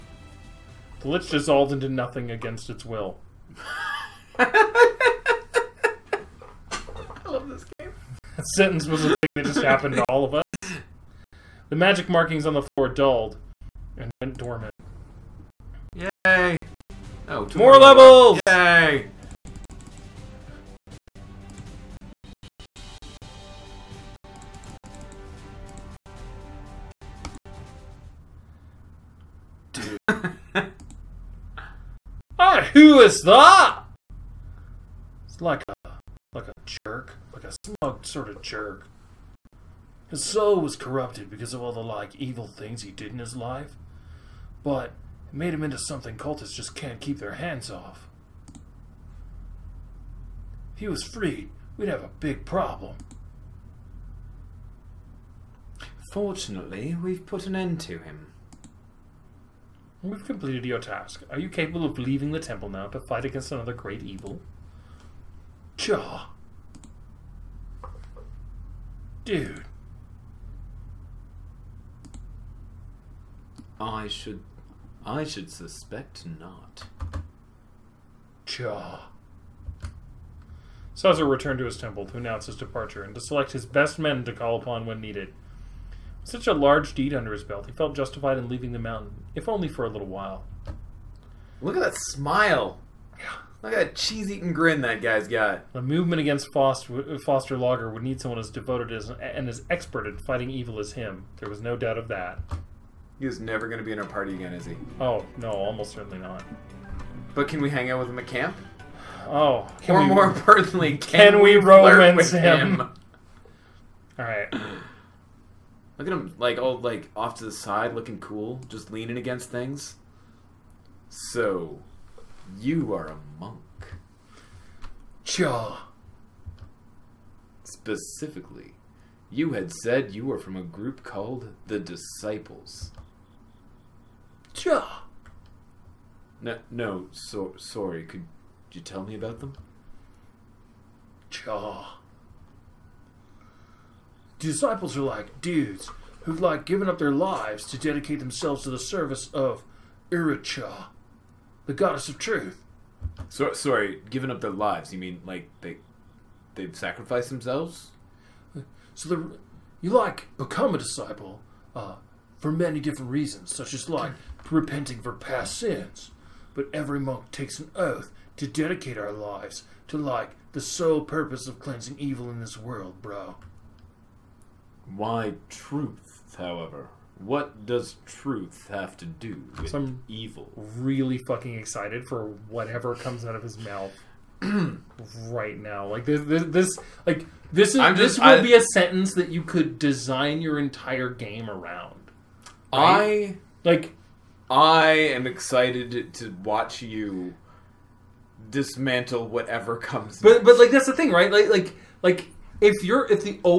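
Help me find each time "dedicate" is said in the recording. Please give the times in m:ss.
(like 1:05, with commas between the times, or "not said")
2:27, 2:48.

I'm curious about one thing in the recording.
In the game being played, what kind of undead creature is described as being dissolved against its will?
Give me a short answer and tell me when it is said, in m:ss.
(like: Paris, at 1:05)
Lich, at 0:01.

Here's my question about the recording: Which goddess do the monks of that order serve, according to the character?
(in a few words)
Iricha.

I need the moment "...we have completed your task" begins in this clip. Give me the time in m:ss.
1:00.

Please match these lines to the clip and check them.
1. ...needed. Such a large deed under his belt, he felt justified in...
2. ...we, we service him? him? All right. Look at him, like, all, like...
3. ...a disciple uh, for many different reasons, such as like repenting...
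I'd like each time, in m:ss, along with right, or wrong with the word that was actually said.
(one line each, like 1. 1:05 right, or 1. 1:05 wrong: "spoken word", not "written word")
1. 1:25 right
2. 1:51 wrong: "romance", not "service"
3. 2:40 right.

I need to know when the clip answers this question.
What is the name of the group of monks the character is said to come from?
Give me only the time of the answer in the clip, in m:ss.
2:11.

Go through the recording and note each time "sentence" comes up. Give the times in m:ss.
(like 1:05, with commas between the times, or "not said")
0:08, 3:08.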